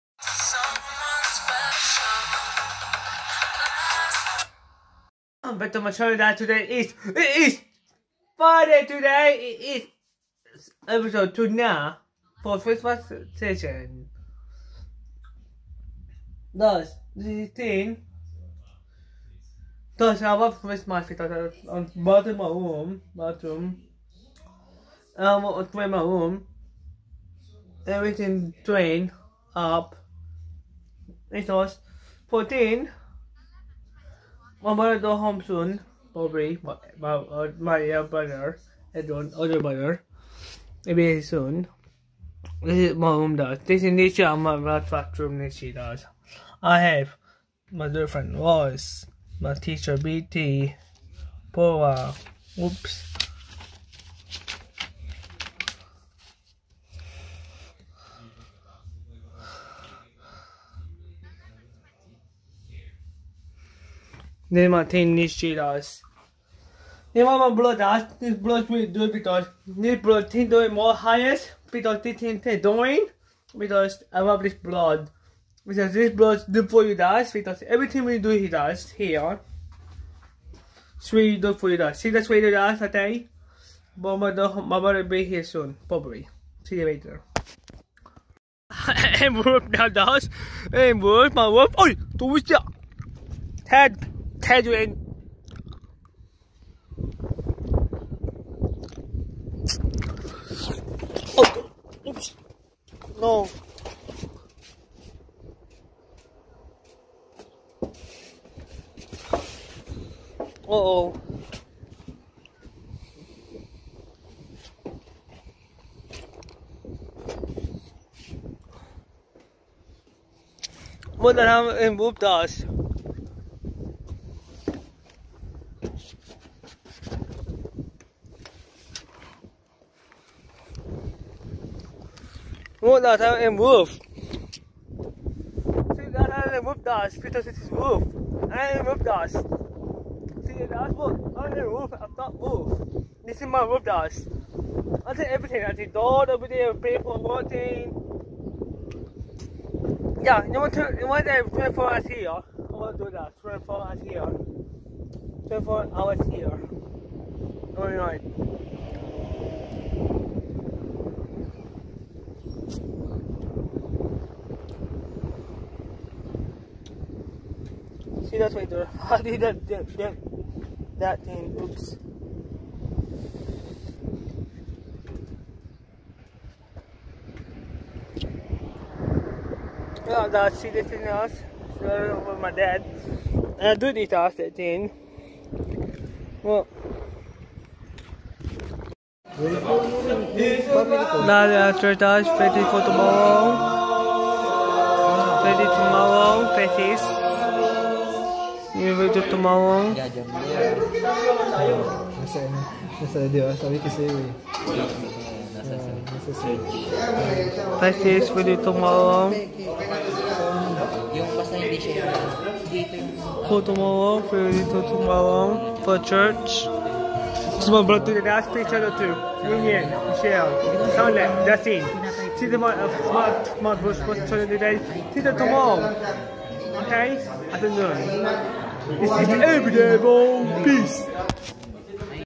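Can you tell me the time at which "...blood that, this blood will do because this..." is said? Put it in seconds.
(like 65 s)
67 s.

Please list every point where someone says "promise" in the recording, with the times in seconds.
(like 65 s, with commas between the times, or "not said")
not said.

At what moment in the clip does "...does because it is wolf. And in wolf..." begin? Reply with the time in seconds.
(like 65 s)
136 s.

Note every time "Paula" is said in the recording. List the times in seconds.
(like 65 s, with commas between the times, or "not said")
51 s.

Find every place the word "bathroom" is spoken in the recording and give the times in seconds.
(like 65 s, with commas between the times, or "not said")
23 s, 44 s.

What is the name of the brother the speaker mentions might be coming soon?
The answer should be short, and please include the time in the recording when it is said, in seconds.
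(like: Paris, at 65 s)
Edwin, at 38 s.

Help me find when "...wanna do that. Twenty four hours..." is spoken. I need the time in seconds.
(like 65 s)
152 s.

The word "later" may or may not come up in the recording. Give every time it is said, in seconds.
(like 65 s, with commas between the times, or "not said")
86 s.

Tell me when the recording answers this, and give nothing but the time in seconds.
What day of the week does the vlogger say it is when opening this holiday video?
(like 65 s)
8 s.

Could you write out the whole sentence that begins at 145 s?
I did everything, I did door over there, paper, working.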